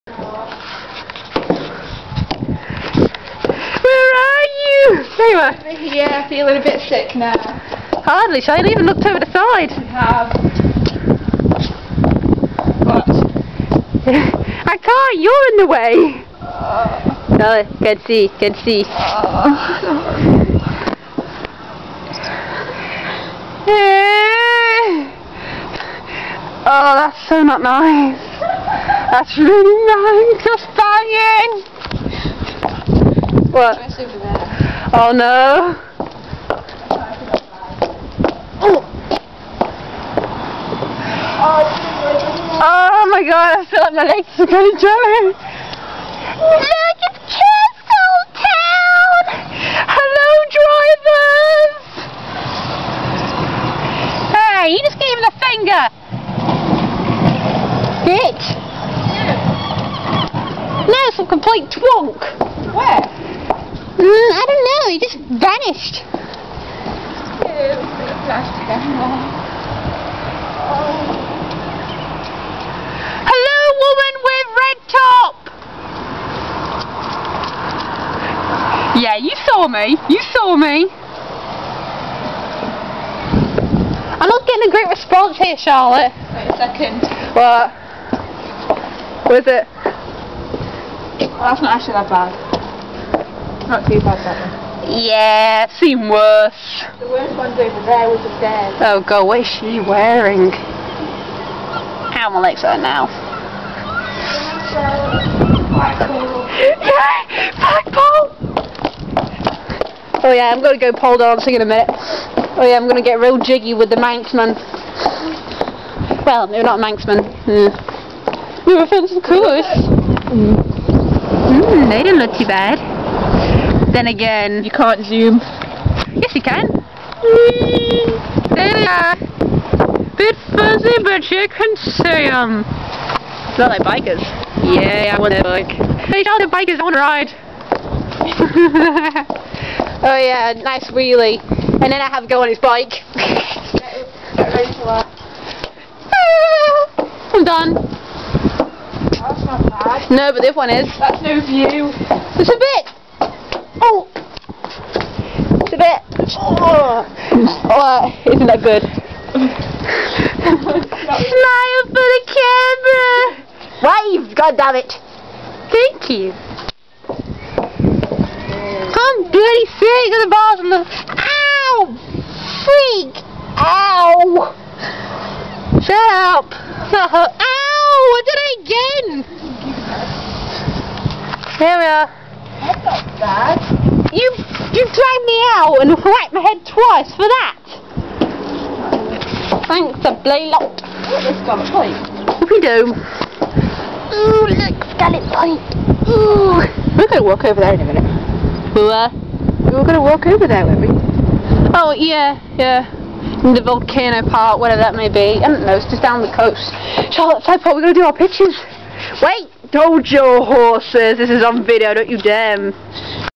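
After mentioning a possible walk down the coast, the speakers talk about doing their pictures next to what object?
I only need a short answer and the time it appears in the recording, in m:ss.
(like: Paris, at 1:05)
flagpole, at 3:27.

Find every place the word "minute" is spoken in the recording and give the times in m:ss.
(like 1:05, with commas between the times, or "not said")
1:51, 3:17.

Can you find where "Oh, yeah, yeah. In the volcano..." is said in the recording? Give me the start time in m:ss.
3:21.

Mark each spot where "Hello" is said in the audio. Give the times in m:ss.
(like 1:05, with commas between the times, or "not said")
0:49, 1:13.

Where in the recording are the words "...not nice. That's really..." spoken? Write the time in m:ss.
0:27.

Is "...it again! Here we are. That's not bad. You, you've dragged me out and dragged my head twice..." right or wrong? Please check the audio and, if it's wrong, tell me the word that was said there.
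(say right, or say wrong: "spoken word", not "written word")
wrong: "whacked", not "dragged".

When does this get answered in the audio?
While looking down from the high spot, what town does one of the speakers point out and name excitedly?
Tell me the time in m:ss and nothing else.
0:47.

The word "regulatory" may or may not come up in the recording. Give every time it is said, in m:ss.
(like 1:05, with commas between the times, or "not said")
not said.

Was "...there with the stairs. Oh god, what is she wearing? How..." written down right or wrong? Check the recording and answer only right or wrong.
right.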